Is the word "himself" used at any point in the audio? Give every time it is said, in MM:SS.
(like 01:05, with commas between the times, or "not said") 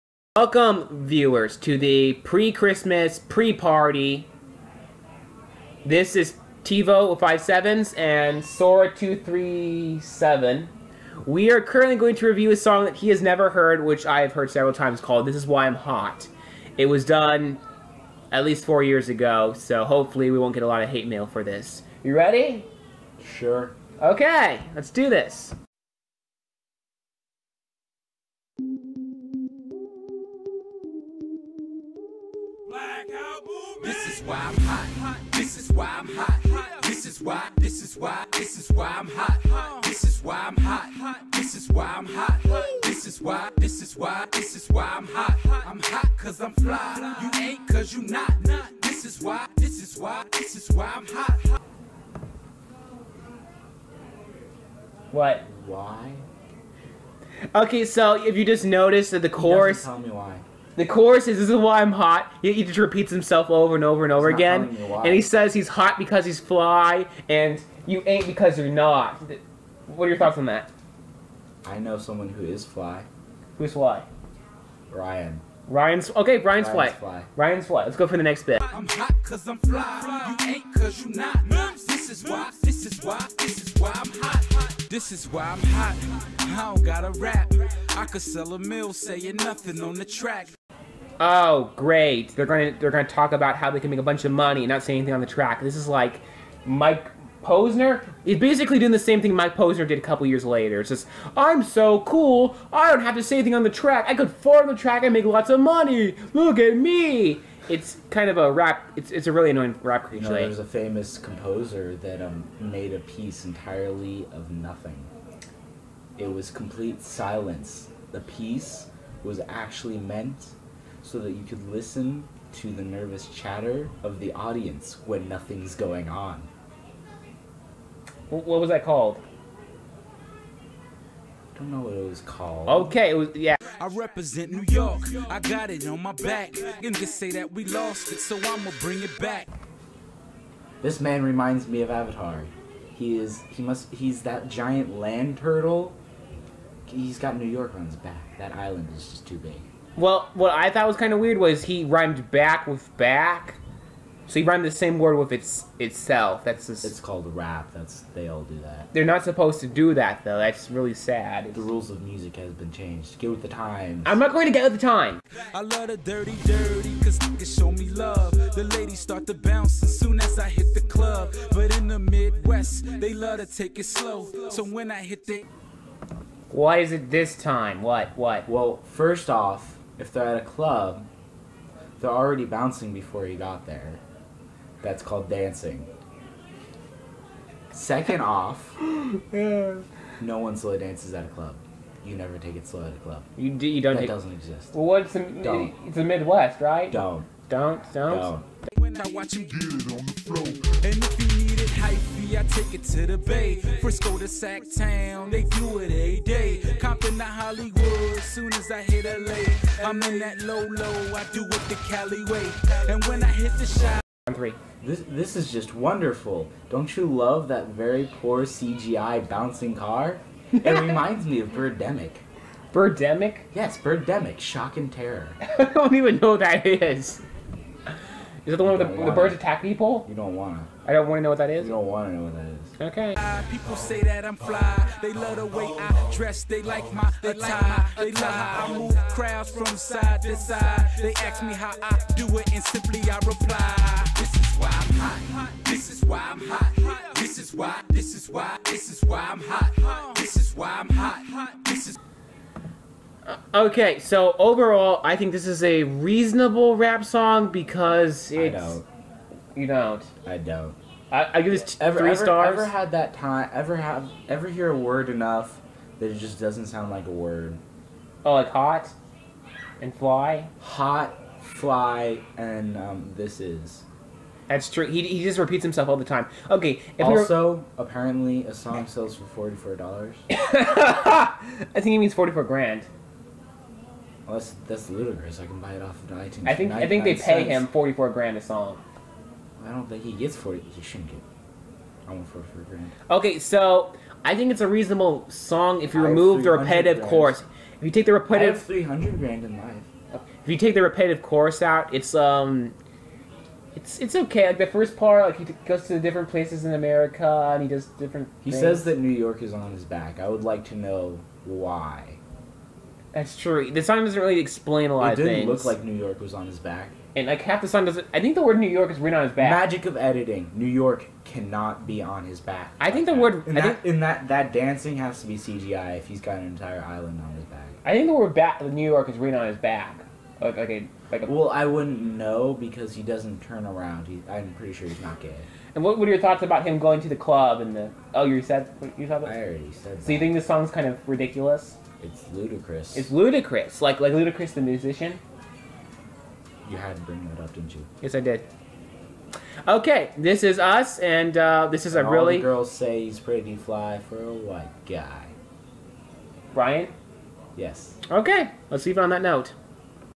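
01:03, 04:35.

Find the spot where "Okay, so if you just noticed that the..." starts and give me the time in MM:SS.
00:57.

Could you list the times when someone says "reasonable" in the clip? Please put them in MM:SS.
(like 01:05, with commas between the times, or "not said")
04:15, 04:54.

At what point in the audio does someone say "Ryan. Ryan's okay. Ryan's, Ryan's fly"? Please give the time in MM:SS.
01:14.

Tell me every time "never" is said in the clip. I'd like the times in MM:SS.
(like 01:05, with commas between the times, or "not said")
00:13, 03:12.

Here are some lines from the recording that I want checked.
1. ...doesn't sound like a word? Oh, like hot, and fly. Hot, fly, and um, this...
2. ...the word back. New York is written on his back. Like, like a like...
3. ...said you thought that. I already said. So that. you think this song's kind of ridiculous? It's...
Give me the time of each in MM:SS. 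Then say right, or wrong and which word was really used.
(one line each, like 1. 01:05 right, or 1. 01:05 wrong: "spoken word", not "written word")
1. 04:26 right
2. 05:28 right
3. 05:38 right.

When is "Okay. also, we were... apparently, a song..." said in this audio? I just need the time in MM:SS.
04:36.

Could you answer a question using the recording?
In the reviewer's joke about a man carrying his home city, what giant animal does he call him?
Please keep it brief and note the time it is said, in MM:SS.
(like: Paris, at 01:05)
Giant land turtle, at 02:24.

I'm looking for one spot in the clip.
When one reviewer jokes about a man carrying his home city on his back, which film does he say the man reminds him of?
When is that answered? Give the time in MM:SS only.
02:21.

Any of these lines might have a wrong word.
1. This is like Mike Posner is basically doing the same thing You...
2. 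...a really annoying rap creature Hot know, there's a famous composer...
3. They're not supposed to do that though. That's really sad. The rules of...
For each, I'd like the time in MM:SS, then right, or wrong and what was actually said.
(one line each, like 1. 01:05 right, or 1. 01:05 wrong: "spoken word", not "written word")
1. 01:35 wrong: "Mike", not "You"
2. 01:49 wrong: "You", not "Hot"
3. 02:38 right.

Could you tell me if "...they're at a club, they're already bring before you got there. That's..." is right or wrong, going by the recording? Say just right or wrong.
wrong.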